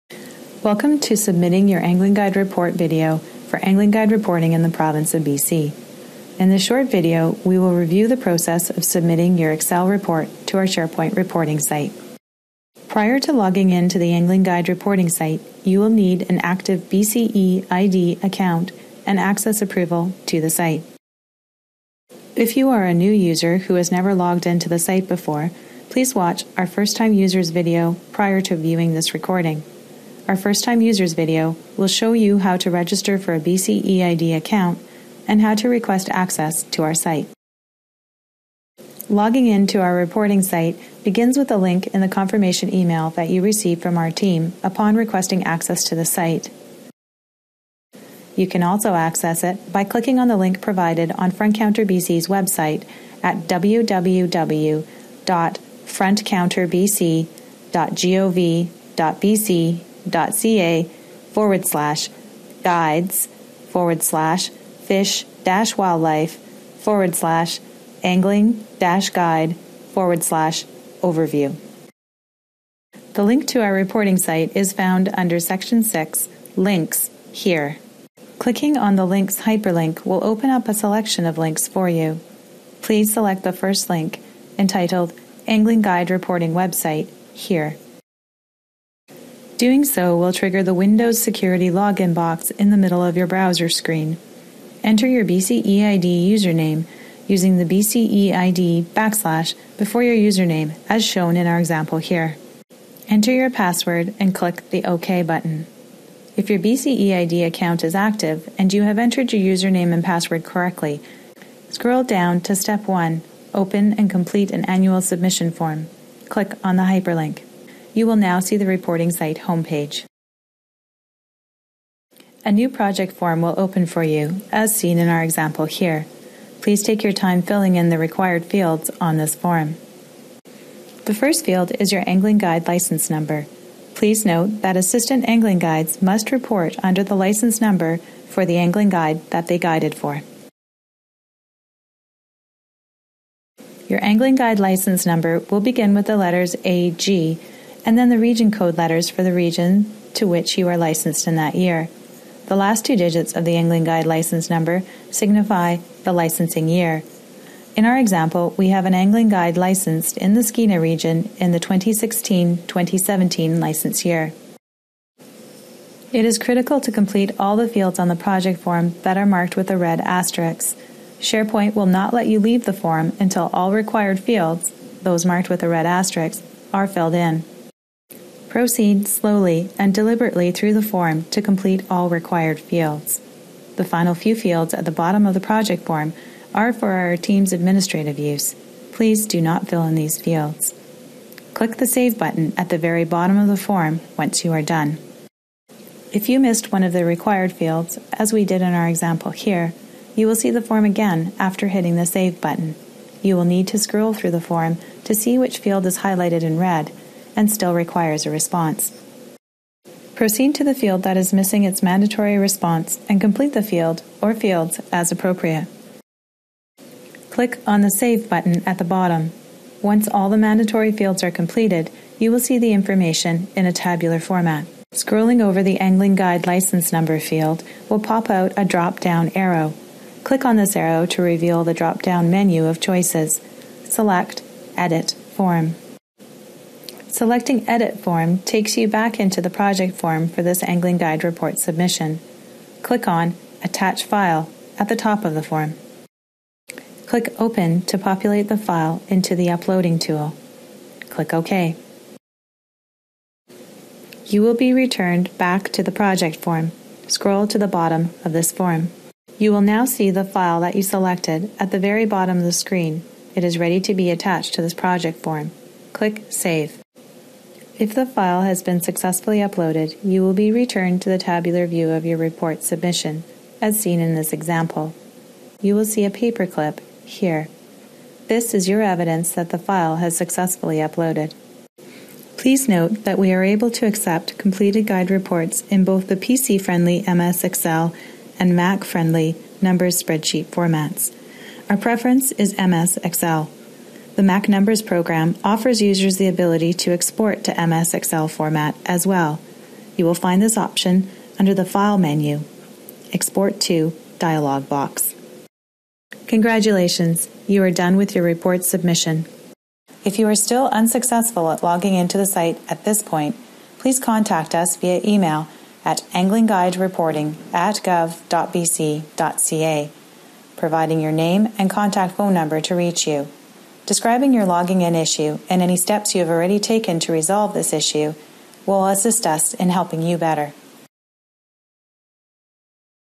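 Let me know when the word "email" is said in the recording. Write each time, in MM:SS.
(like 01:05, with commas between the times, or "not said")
00:42, 05:15.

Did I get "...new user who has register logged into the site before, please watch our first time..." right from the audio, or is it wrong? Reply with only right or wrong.
wrong.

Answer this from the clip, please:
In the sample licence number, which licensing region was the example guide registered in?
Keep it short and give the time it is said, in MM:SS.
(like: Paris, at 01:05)
Skeena, at 02:40.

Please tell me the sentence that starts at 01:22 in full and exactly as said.
Please select the first link entitled Angling Guide Reporting Website here.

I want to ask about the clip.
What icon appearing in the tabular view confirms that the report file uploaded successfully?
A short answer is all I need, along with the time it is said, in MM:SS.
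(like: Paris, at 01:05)
paperclip, at 04:36.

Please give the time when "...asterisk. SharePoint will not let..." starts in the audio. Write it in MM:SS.
02:50.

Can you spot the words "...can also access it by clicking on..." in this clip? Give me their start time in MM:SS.
00:48.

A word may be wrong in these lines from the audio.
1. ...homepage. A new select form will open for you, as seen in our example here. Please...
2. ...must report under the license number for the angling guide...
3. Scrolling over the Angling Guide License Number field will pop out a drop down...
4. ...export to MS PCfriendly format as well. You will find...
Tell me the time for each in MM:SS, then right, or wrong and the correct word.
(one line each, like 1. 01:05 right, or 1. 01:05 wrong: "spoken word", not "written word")
1. 01:59 wrong: "project", not "select"
2. 02:16 right
3. 03:44 right
4. 04:56 wrong: "Excel", not "PCfriendly".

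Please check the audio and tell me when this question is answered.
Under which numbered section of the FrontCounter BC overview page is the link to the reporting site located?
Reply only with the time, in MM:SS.
01:15.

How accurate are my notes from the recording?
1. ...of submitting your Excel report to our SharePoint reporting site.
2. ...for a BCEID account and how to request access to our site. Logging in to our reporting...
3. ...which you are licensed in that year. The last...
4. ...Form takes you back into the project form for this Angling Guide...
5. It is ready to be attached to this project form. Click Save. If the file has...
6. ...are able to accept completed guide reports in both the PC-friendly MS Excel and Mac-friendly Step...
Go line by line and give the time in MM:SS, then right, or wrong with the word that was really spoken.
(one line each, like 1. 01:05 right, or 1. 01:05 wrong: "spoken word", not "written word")
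1. 00:08 right
2. 00:33 right
3. 02:30 right
4. 03:57 right
5. 04:23 right
6. 04:43 wrong: "Numbers", not "Step".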